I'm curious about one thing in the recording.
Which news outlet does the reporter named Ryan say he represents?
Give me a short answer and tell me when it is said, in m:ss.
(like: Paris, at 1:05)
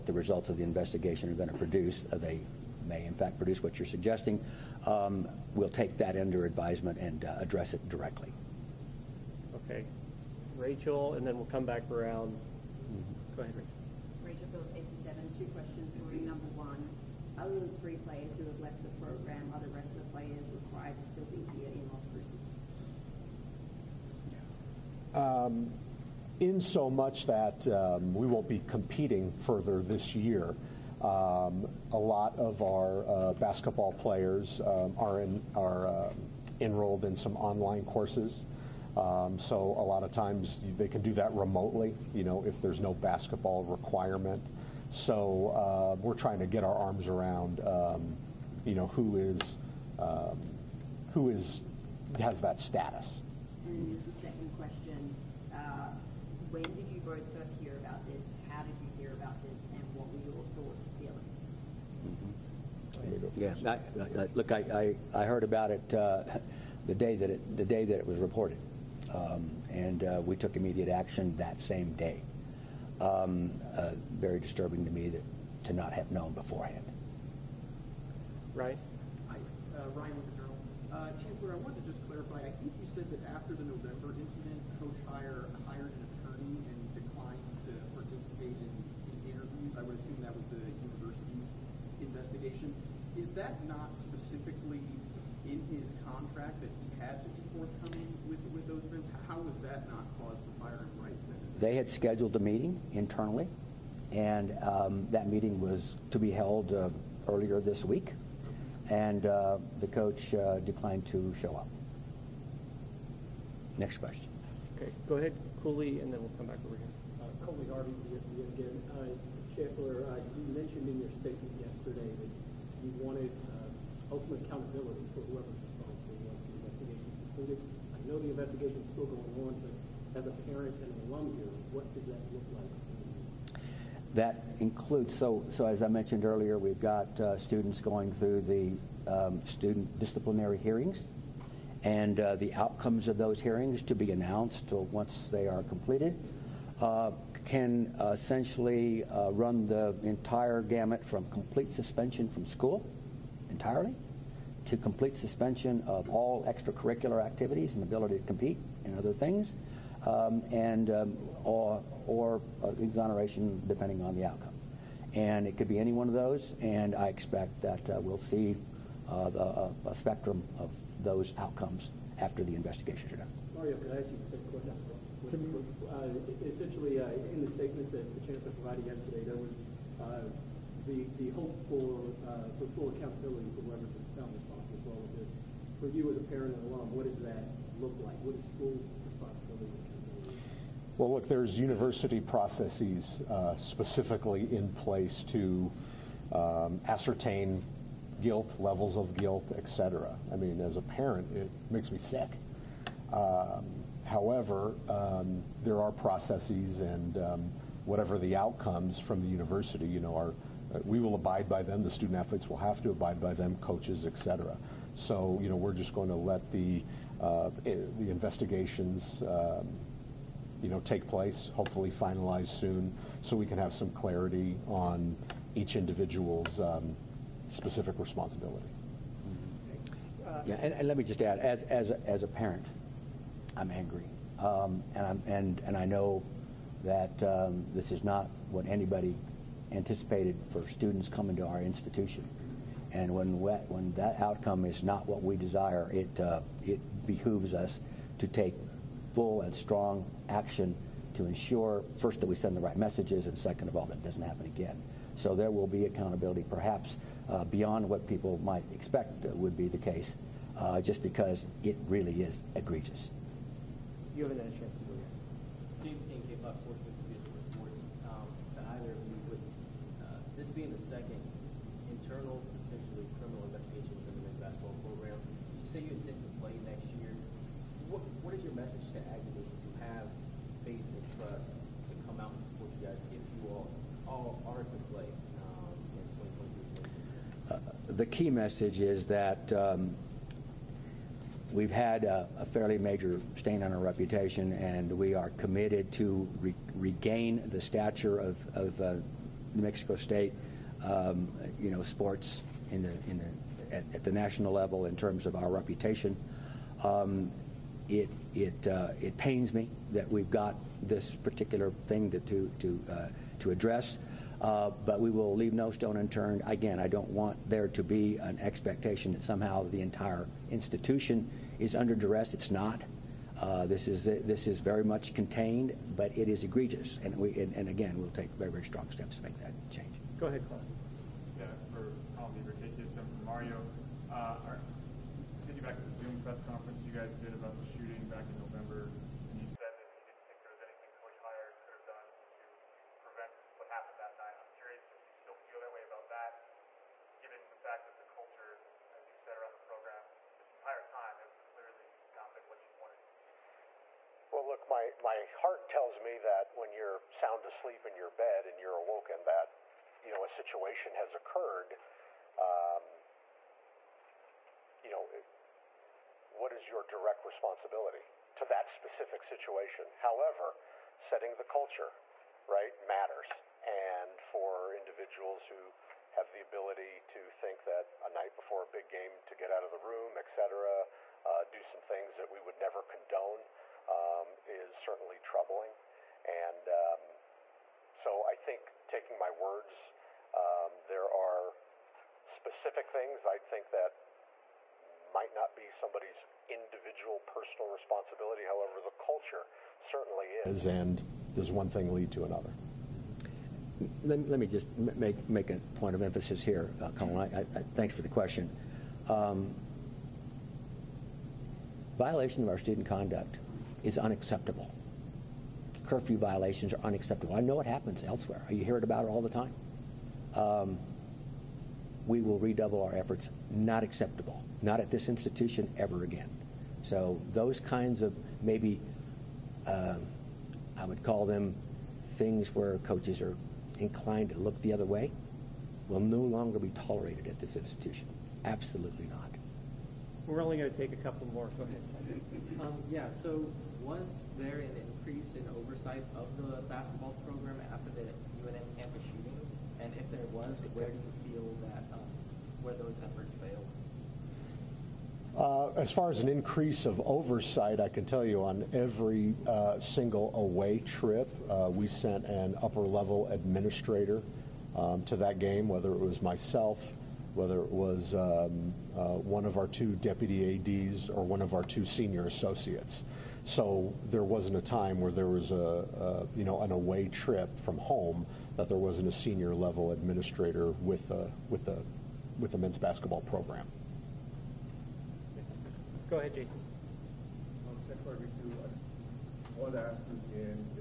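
the Journal, at 1:20.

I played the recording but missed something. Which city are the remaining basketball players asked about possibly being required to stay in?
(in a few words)
Las Cruces.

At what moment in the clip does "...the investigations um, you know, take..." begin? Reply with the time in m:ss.
3:37.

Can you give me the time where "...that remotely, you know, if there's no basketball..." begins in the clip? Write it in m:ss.
0:41.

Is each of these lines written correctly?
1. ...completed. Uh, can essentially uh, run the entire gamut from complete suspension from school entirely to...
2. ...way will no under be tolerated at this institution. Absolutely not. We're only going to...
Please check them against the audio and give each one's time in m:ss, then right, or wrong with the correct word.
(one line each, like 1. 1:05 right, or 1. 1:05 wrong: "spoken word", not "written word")
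1. 2:25 right
2. 7:14 wrong: "longer", not "under".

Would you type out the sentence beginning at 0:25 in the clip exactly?
Um, in so much that um, we won't be competing further this year.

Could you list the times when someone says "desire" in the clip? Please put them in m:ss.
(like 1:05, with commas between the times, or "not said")
4:05.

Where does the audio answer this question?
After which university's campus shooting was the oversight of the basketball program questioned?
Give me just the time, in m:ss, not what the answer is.
7:28.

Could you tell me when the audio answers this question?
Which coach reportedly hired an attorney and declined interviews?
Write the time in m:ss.
1:25.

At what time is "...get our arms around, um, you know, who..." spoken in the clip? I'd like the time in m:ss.
0:46.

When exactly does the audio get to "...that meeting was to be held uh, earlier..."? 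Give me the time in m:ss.
1:45.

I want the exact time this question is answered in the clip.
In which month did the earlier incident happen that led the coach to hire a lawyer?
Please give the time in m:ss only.
1:23.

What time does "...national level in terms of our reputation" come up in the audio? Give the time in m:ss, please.
5:04.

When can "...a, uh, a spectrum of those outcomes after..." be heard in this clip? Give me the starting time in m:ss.
2:49.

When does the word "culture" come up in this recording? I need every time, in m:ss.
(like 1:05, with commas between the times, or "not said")
6:11, 6:38.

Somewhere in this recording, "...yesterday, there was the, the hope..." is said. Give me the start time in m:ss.
2:58.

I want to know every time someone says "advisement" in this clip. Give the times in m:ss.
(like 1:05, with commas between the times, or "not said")
0:06.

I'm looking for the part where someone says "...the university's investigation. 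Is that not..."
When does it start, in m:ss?
1:30.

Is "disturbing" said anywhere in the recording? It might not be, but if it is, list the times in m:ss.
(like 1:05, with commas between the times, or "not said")
1:14.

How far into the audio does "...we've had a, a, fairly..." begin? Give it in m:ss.
4:51.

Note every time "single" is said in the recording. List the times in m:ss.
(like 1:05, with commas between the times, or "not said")
7:39.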